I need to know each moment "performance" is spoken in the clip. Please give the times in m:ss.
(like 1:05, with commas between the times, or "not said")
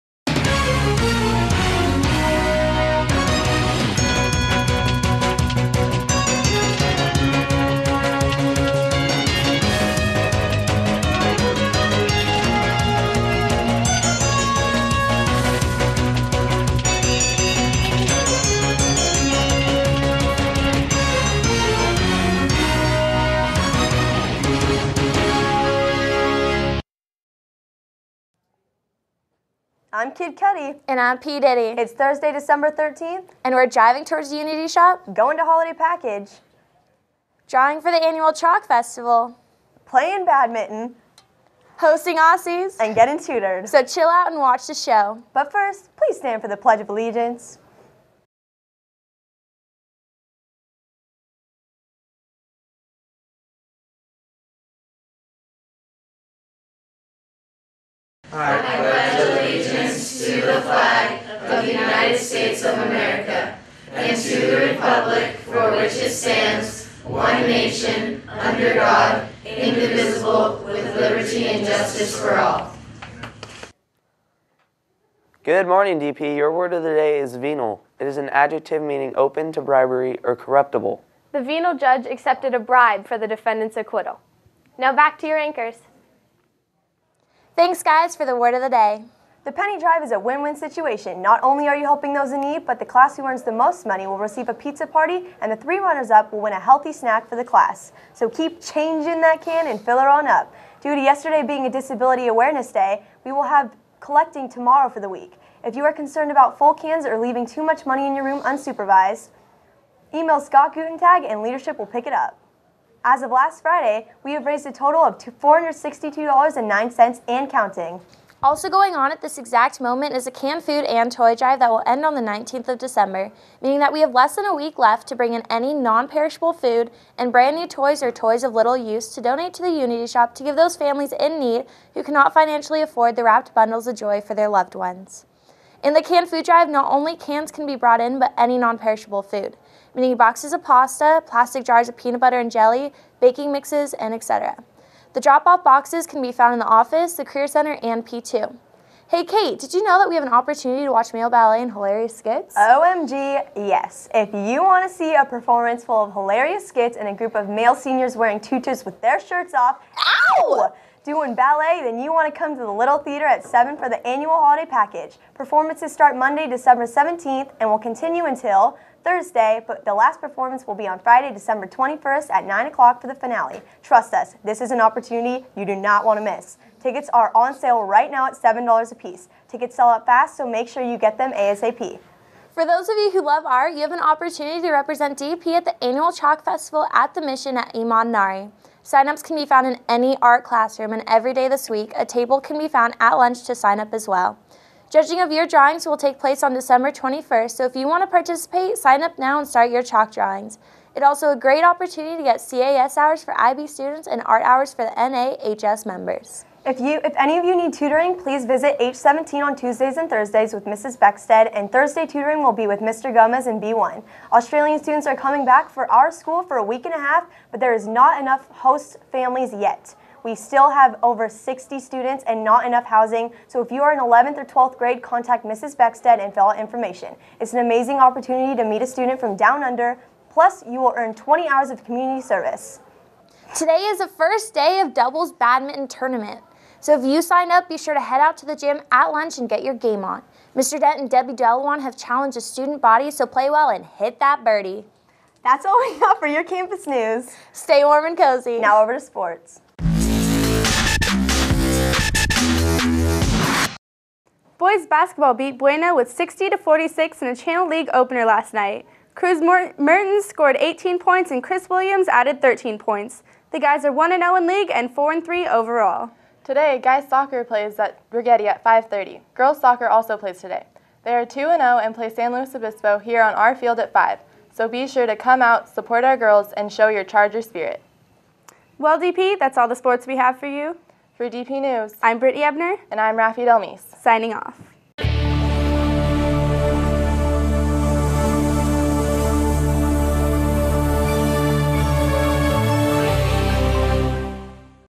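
2:35, 2:45, 2:50.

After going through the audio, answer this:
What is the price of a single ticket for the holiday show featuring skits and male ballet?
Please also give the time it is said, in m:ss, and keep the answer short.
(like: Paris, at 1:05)
$7, at 2:58.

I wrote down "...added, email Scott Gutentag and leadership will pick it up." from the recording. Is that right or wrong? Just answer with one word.
wrong.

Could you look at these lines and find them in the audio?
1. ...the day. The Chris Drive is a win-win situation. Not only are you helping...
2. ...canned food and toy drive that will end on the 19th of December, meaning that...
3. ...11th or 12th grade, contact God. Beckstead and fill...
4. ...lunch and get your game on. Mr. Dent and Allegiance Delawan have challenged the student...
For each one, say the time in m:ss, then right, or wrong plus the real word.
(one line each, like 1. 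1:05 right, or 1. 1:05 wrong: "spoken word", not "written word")
1. 1:28 wrong: "Penny", not "Chris"
2. 2:00 right
3. 3:43 wrong: "Mrs", not "God"
4. 3:59 wrong: "Debbie", not "Allegiance".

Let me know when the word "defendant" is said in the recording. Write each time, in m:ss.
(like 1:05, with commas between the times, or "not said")
1:23.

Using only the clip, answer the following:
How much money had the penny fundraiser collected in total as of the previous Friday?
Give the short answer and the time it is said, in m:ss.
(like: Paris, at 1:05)
$462.09, at 1:55.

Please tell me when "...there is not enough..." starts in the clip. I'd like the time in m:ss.
3:37.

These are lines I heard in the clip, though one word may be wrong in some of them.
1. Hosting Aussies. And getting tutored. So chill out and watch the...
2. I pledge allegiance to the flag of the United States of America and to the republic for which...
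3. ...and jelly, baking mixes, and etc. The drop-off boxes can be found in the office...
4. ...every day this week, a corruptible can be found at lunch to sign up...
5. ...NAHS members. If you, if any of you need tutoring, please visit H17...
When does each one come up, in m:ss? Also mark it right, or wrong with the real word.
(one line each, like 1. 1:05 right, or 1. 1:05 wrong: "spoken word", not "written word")
1. 0:41 right
2. 0:58 right
3. 2:22 right
4. 3:11 wrong: "table", not "corruptible"
5. 3:24 right.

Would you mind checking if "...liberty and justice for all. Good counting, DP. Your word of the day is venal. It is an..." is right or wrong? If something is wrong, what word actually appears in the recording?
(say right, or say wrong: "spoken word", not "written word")
wrong: "morning", not "counting".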